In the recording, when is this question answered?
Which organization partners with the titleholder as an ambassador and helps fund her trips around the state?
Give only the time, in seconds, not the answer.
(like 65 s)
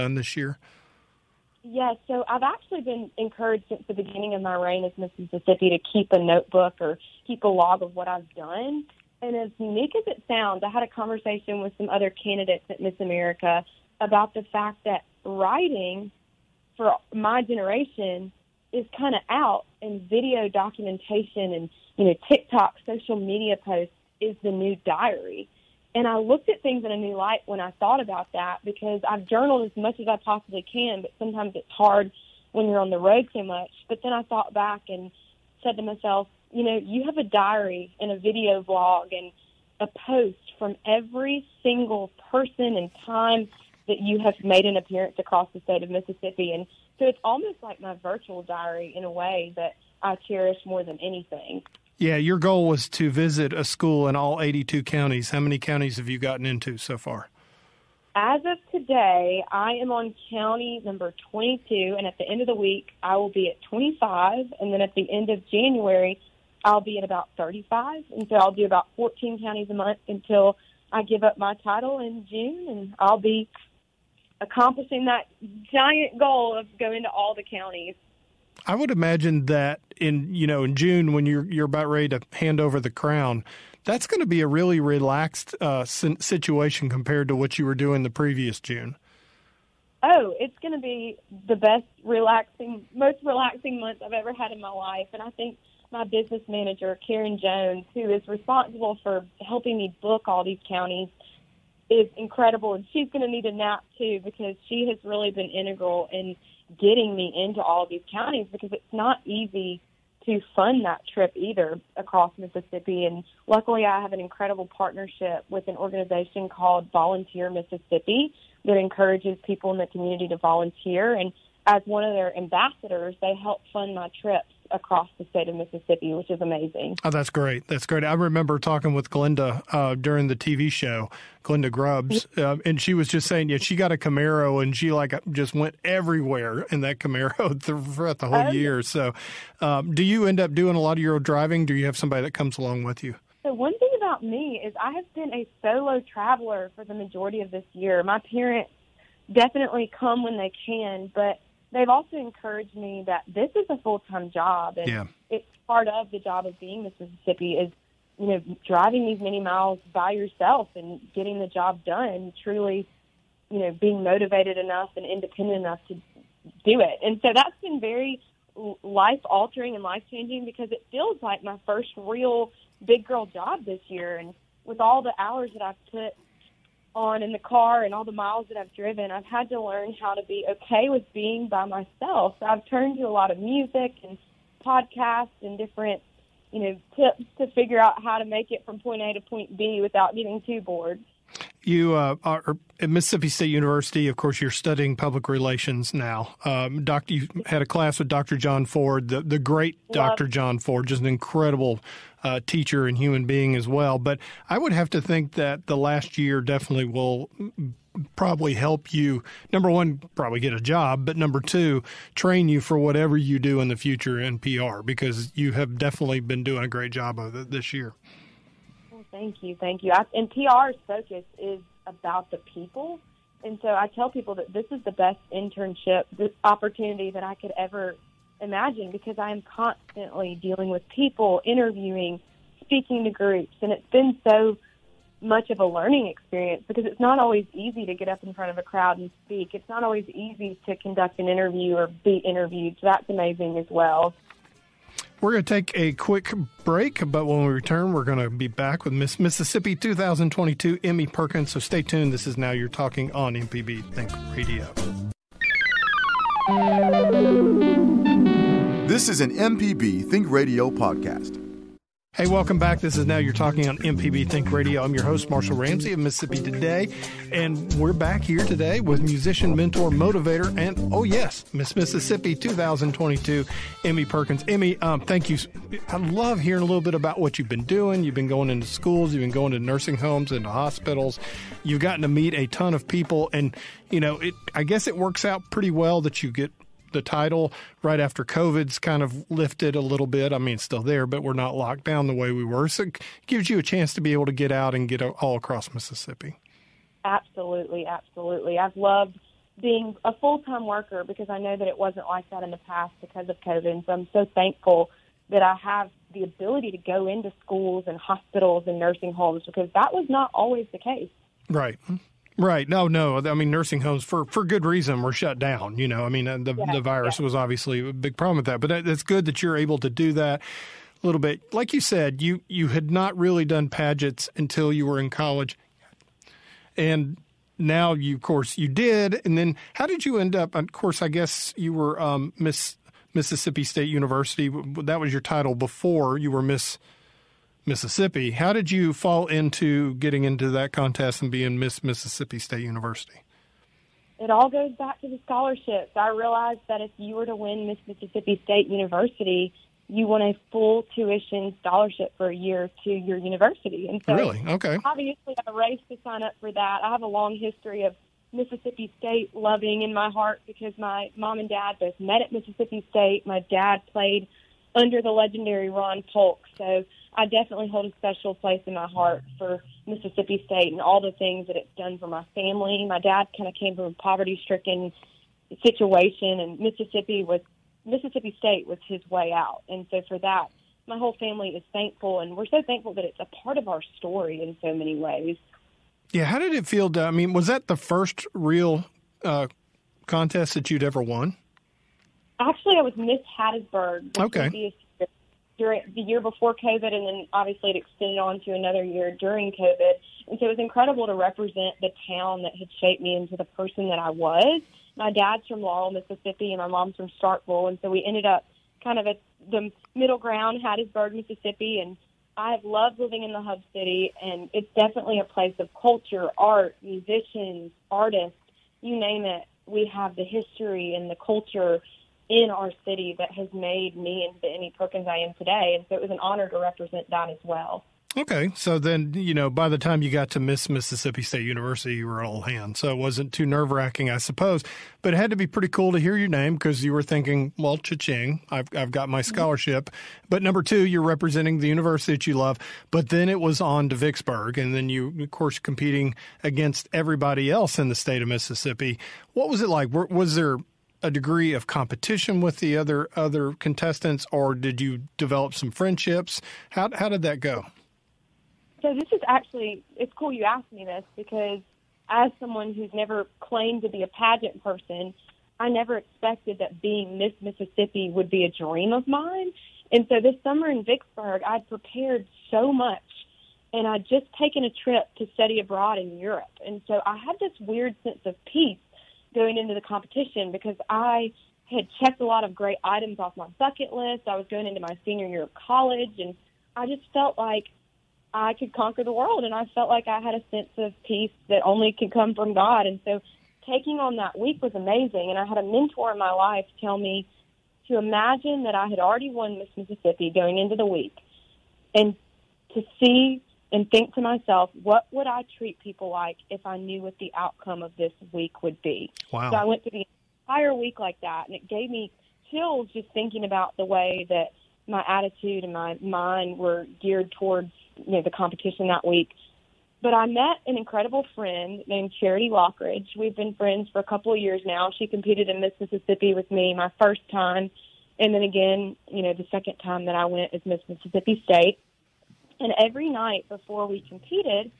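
116 s.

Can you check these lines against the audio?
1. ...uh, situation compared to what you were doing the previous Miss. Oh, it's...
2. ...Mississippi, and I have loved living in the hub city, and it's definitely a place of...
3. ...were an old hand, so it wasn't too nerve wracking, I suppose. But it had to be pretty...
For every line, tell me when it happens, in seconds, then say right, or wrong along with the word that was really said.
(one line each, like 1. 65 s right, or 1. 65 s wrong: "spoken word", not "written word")
1. 85 s wrong: "June", not "Miss"
2. 411 s right
3. 432 s right.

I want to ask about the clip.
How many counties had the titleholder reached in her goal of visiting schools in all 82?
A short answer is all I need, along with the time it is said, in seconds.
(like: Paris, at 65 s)
22, at 60 s.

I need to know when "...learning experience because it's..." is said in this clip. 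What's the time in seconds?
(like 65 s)
235 s.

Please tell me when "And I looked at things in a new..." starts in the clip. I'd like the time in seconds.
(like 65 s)
25 s.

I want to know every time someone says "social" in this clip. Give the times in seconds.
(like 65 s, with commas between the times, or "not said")
22 s.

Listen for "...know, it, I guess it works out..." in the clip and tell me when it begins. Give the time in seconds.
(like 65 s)
284 s.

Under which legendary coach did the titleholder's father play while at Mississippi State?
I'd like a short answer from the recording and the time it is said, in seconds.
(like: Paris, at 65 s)
Ron Polk, at 365 s.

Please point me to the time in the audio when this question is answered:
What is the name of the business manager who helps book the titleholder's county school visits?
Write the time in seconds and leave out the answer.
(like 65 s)
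97 s.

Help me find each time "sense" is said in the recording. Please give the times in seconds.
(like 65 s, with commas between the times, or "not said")
478 s, 490 s.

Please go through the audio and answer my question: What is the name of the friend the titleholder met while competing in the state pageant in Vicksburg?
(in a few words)
Charity Lockridge.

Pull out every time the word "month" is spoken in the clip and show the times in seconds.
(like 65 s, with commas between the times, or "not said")
69 s, 93 s.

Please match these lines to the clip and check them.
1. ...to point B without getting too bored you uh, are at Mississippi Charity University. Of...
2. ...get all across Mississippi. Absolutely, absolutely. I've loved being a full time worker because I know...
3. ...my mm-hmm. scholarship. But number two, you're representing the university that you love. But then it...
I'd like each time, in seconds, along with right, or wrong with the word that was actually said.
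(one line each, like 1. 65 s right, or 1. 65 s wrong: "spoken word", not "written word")
1. 189 s wrong: "State", not "Charity"
2. 294 s right
3. 439 s right.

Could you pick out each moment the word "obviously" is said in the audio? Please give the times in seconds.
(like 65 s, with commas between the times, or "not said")
317 s, 354 s, 397 s.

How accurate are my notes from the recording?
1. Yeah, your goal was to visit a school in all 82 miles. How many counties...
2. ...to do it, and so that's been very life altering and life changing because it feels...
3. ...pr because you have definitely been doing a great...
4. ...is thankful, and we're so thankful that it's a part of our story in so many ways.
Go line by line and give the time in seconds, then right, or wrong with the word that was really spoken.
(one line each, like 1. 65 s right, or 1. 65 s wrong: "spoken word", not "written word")
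1. 51 s wrong: "counties", not "miles"
2. 165 s right
3. 214 s right
4. 381 s right.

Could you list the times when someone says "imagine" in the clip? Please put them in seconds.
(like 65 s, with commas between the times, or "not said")
78 s, 228 s, 497 s.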